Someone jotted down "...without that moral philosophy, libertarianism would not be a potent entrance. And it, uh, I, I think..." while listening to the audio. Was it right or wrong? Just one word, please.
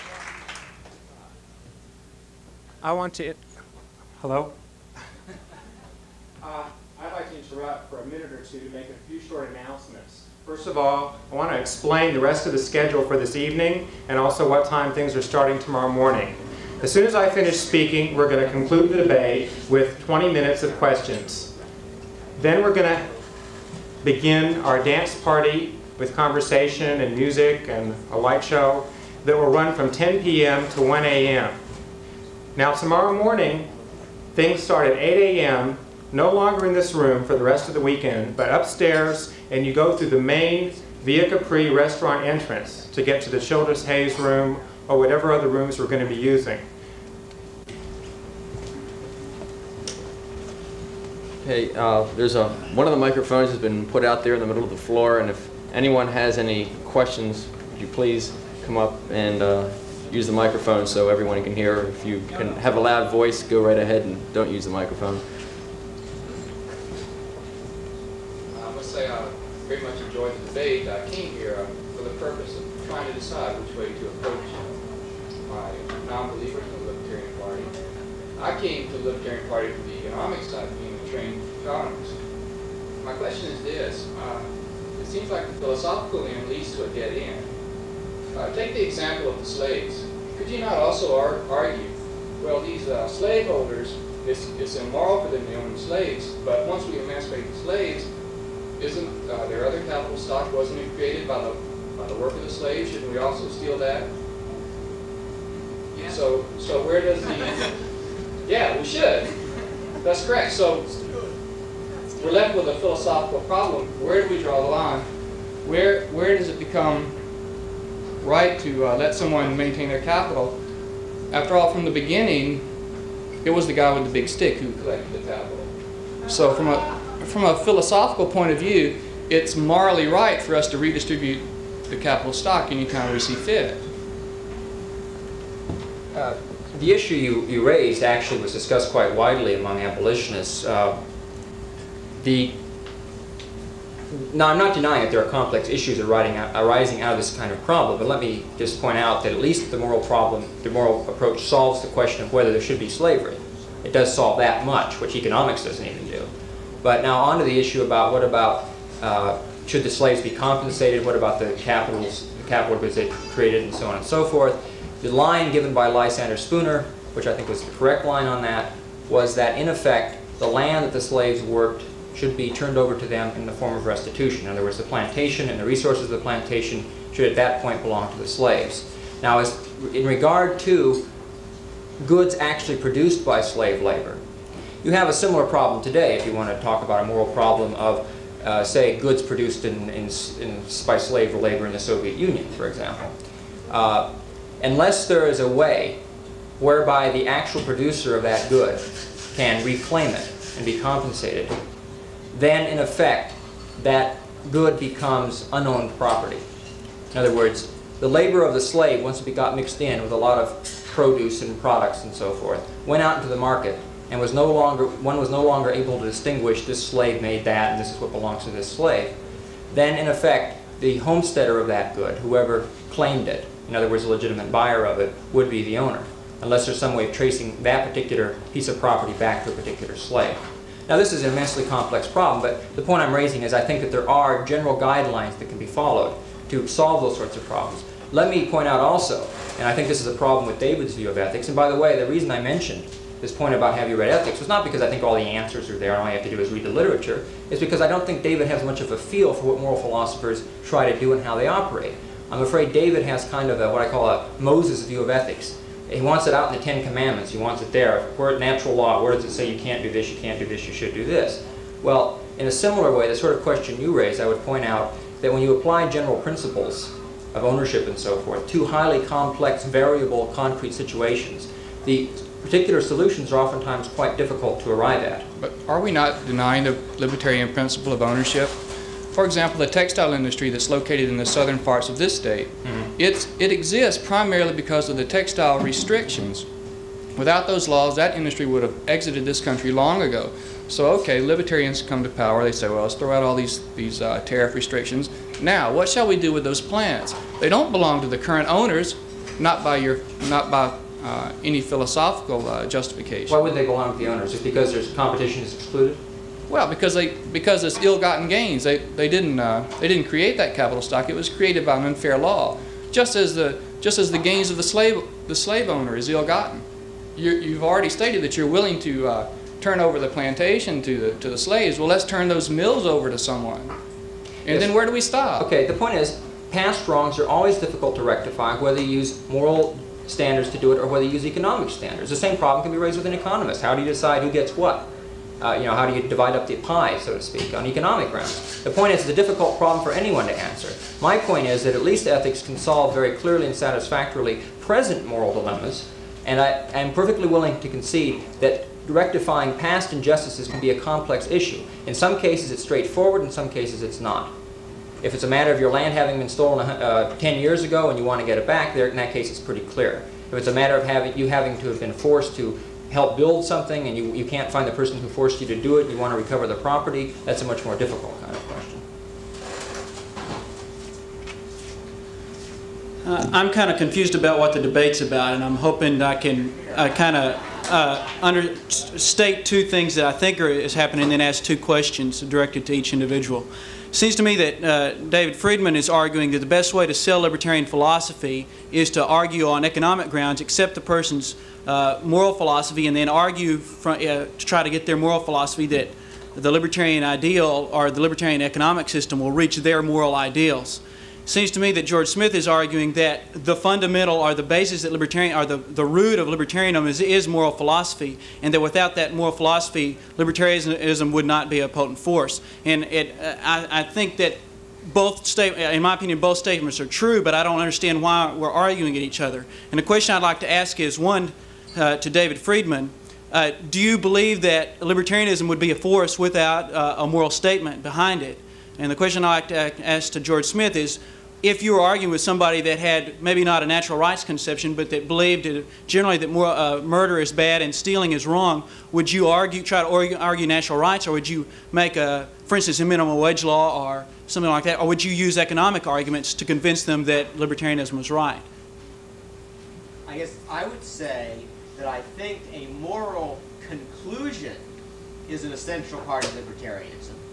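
wrong.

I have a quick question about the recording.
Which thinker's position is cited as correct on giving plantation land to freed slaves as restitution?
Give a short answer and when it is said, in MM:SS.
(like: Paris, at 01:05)
Lysander Spooner, at 02:45.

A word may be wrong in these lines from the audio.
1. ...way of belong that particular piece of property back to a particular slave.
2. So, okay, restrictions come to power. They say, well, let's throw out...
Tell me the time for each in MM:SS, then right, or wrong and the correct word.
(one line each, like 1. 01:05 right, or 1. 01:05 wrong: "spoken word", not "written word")
1. 03:46 wrong: "tracing", not "belong"
2. 04:50 wrong: "libertarians", not "restrictions".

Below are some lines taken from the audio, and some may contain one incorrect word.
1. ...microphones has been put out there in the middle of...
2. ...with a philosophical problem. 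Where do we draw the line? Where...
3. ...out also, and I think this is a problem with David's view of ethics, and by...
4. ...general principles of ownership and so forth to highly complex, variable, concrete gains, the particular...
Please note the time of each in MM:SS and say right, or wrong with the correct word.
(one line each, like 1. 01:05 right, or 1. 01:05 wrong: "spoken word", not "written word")
1. 00:52 right
2. 01:52 right
3. 03:58 right
4. 04:25 wrong: "situations", not "gains".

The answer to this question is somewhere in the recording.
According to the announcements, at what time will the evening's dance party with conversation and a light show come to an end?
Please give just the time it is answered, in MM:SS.
00:30.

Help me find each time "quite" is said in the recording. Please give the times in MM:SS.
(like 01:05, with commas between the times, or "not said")
02:18, 04:33.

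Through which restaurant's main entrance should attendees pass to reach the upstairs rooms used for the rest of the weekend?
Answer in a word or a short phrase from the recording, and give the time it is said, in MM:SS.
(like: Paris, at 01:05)
Via Capri, at 00:41.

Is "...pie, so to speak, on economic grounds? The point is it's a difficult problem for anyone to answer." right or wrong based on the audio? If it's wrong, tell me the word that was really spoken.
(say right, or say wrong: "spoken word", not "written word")
right.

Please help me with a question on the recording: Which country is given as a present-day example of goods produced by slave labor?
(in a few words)
Soviet Union.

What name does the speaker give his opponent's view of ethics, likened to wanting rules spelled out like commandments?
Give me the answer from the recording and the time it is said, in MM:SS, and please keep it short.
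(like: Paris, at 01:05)
Moses view, at 04:14.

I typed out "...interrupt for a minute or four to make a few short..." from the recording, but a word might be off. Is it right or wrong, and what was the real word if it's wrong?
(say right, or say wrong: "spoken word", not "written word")
wrong: "two", not "four".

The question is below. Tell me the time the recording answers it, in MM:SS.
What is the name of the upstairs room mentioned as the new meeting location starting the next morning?
00:43.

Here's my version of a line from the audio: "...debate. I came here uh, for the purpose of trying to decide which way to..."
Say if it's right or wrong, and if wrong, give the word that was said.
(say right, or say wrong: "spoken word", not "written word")
right.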